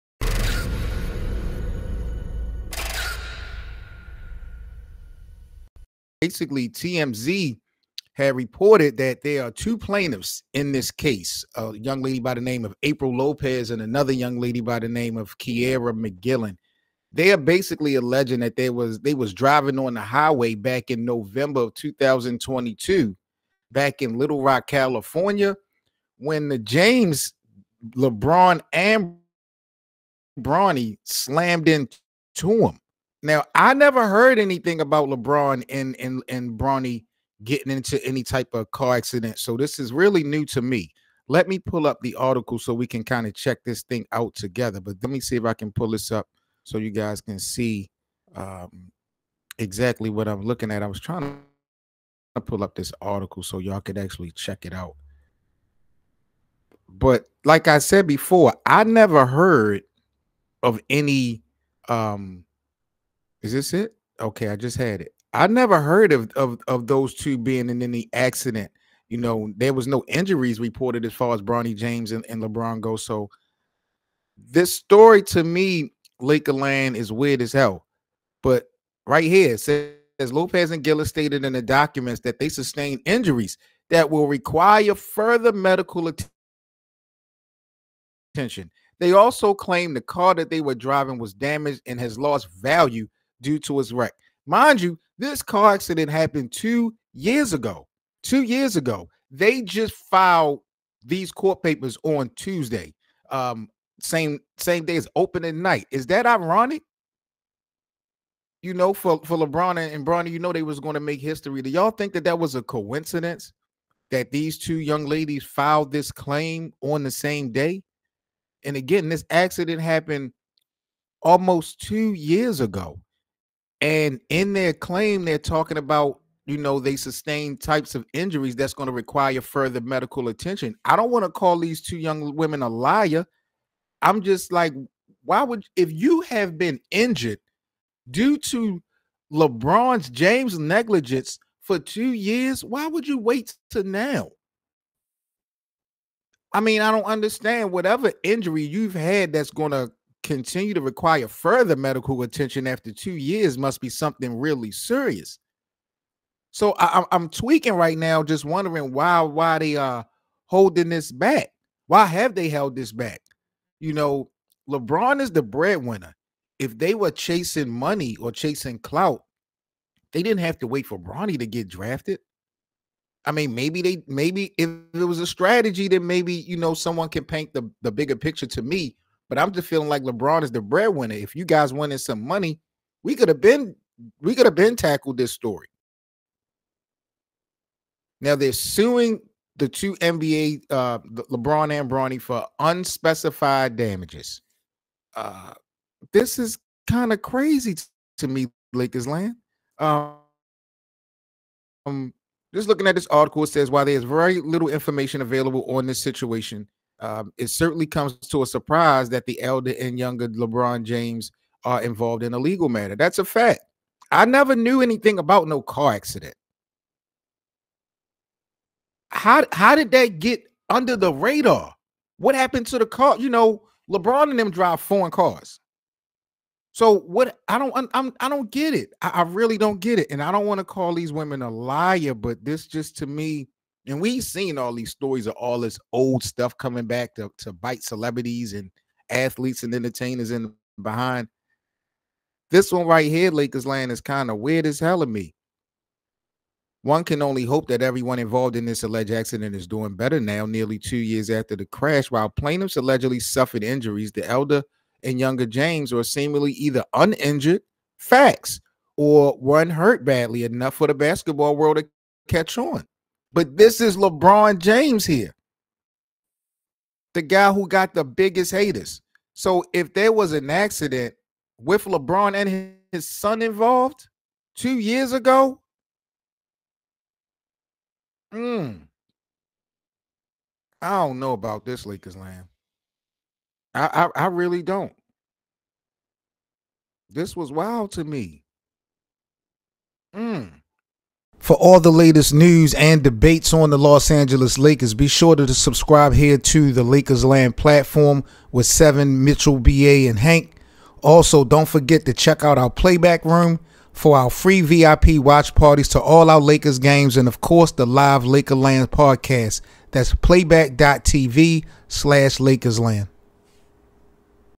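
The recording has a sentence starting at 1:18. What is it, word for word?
But right here it says Lopez and Gillis stated in the documents that they sustained injuries that will require further medical attention.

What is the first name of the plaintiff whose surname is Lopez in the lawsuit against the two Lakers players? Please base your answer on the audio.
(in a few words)
April.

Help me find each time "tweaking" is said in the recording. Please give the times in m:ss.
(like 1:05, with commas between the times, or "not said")
2:37.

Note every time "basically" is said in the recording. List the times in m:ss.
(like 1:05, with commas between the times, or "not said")
0:06, 0:17.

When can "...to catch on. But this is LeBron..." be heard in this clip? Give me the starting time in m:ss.
4:21.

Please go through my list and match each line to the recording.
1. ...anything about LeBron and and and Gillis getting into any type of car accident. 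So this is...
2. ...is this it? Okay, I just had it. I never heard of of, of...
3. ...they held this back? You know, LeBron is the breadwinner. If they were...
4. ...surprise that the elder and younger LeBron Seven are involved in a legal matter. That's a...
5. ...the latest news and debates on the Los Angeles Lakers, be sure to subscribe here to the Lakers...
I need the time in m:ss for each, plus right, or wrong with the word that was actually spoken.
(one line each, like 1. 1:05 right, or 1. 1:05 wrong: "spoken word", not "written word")
1. 0:34 wrong: "Bronny", not "Gillis"
2. 1:03 right
3. 2:42 right
4. 3:28 wrong: "James", not "Seven"
5. 4:51 right.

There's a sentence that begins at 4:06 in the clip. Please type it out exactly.
One can only hope that everyone involved in this alleged accident is doing better now, nearly two years after the crash.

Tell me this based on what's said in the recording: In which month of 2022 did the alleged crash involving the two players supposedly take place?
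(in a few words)
November.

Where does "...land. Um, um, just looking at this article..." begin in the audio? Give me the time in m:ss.
3:19.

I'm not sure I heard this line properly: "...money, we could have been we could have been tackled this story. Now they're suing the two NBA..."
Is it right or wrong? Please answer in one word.
right.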